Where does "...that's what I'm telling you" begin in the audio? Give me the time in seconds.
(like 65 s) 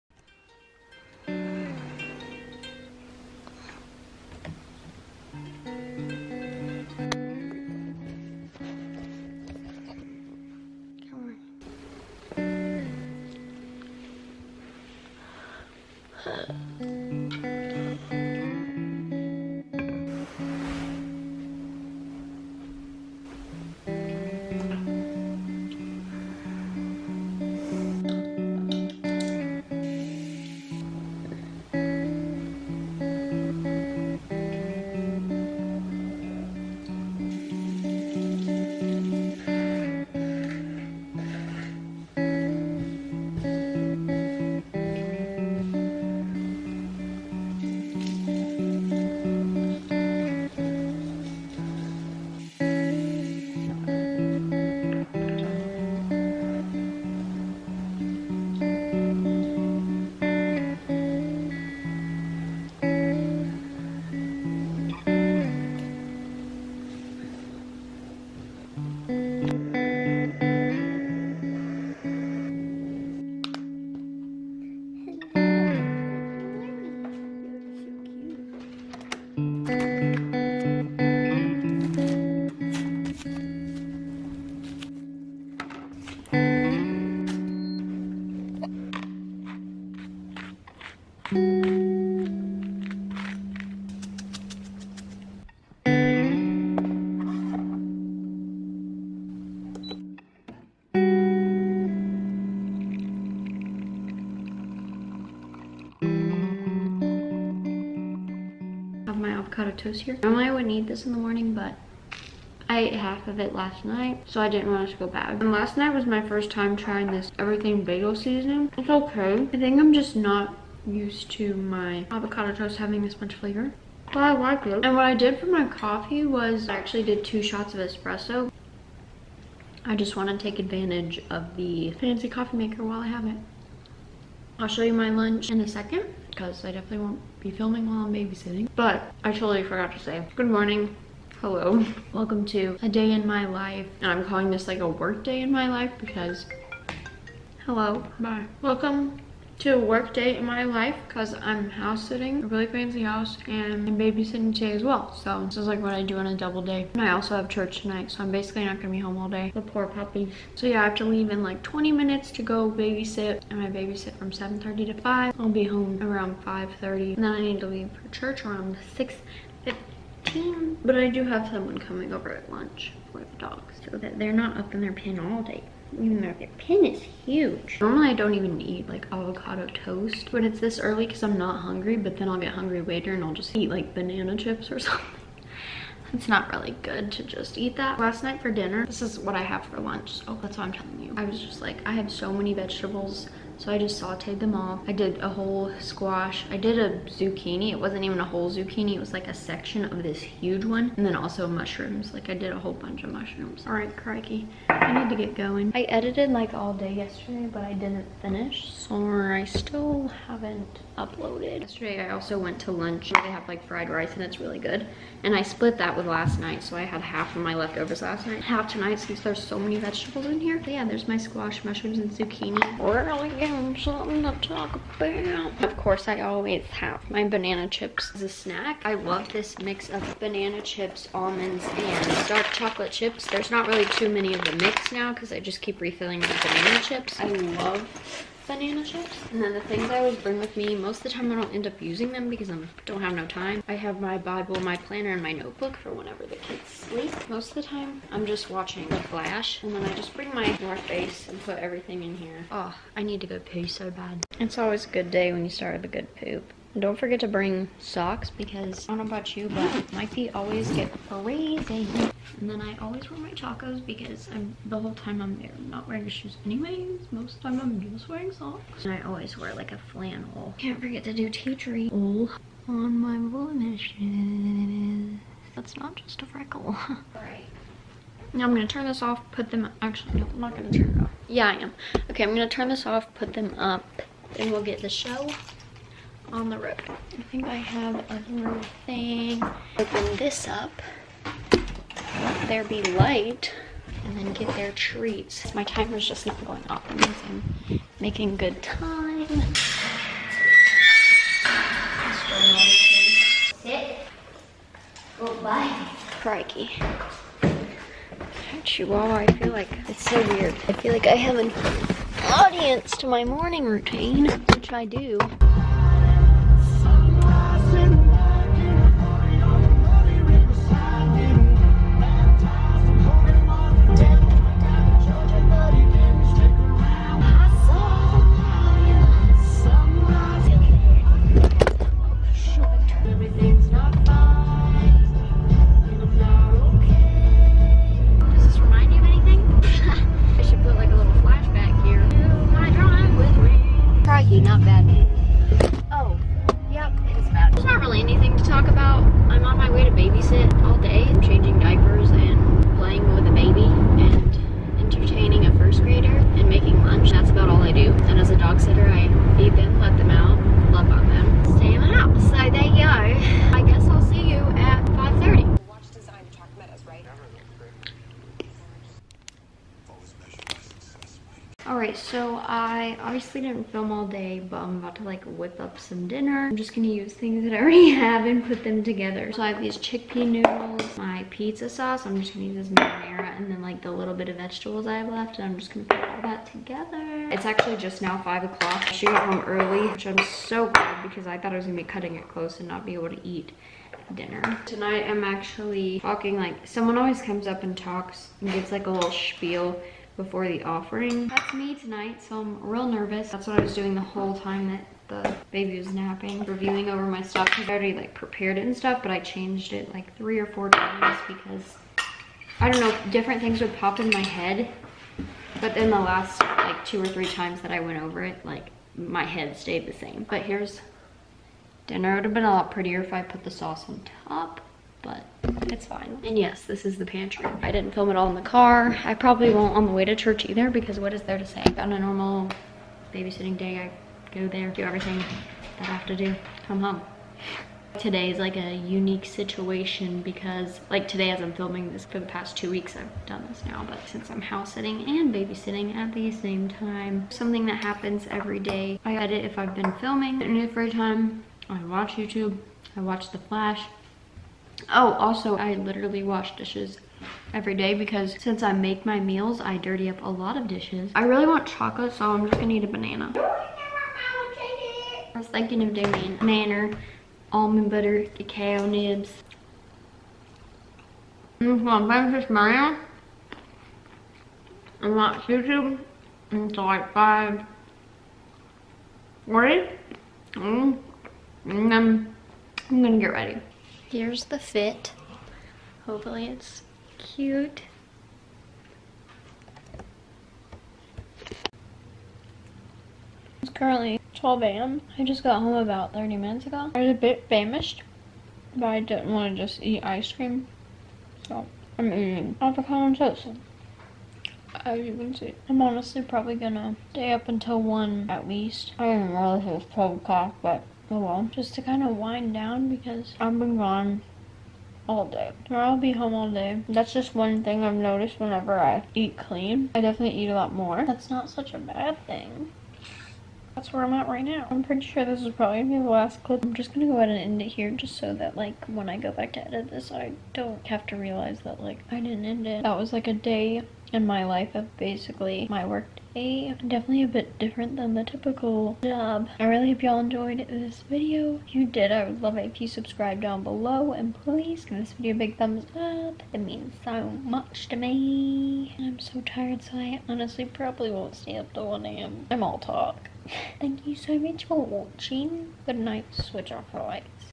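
190 s.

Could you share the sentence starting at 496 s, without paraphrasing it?
I was a bit famished, but I didn't want to just eat ice cream.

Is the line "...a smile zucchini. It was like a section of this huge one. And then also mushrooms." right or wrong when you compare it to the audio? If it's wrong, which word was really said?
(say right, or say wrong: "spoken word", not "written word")
wrong: "whole", not "smile".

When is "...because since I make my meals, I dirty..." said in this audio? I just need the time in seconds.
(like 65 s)
457 s.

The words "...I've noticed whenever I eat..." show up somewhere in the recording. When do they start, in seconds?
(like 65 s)
517 s.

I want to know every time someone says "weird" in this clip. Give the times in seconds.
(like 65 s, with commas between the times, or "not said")
310 s.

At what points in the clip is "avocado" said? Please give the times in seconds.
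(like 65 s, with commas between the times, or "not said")
109 s, 122 s, 179 s, 502 s.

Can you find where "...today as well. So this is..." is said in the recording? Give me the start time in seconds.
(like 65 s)
154 s.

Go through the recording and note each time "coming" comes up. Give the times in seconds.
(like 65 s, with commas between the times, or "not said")
171 s.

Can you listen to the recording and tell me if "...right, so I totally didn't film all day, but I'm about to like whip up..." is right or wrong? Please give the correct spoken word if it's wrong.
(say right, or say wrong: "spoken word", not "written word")
wrong: "obviously", not "totally".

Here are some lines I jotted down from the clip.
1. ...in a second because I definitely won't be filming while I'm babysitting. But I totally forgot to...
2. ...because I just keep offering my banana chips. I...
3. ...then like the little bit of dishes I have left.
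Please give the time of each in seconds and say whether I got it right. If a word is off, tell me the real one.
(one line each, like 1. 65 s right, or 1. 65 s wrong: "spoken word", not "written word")
1. 135 s right
2. 235 s wrong: "refilling", not "offering"
3. 383 s wrong: "vegetables", not "dishes".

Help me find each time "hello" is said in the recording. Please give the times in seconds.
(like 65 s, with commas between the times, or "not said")
141 s, 147 s.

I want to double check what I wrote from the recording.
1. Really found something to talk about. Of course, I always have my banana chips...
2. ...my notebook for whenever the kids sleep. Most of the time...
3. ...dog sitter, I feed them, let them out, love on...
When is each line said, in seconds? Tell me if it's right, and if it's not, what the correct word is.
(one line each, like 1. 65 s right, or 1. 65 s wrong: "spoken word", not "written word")
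1. 223 s right
2. 245 s right
3. 358 s right.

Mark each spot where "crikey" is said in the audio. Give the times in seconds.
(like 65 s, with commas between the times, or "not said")
203 s, 306 s.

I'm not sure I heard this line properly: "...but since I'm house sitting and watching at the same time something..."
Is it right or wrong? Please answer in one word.
wrong.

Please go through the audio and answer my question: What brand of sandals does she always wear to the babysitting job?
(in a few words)
Chacos.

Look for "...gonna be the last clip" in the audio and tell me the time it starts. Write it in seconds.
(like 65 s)
525 s.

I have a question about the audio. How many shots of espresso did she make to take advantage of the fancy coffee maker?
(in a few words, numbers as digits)
2.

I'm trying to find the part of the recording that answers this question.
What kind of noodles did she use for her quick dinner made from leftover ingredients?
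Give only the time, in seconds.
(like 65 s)
379 s.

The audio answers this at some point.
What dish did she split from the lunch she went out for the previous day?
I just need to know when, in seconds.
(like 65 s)
213 s.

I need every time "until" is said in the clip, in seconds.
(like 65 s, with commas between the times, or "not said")
476 s, 507 s.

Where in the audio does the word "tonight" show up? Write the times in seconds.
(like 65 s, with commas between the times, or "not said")
157 s, 218 s, 394 s, 401 s.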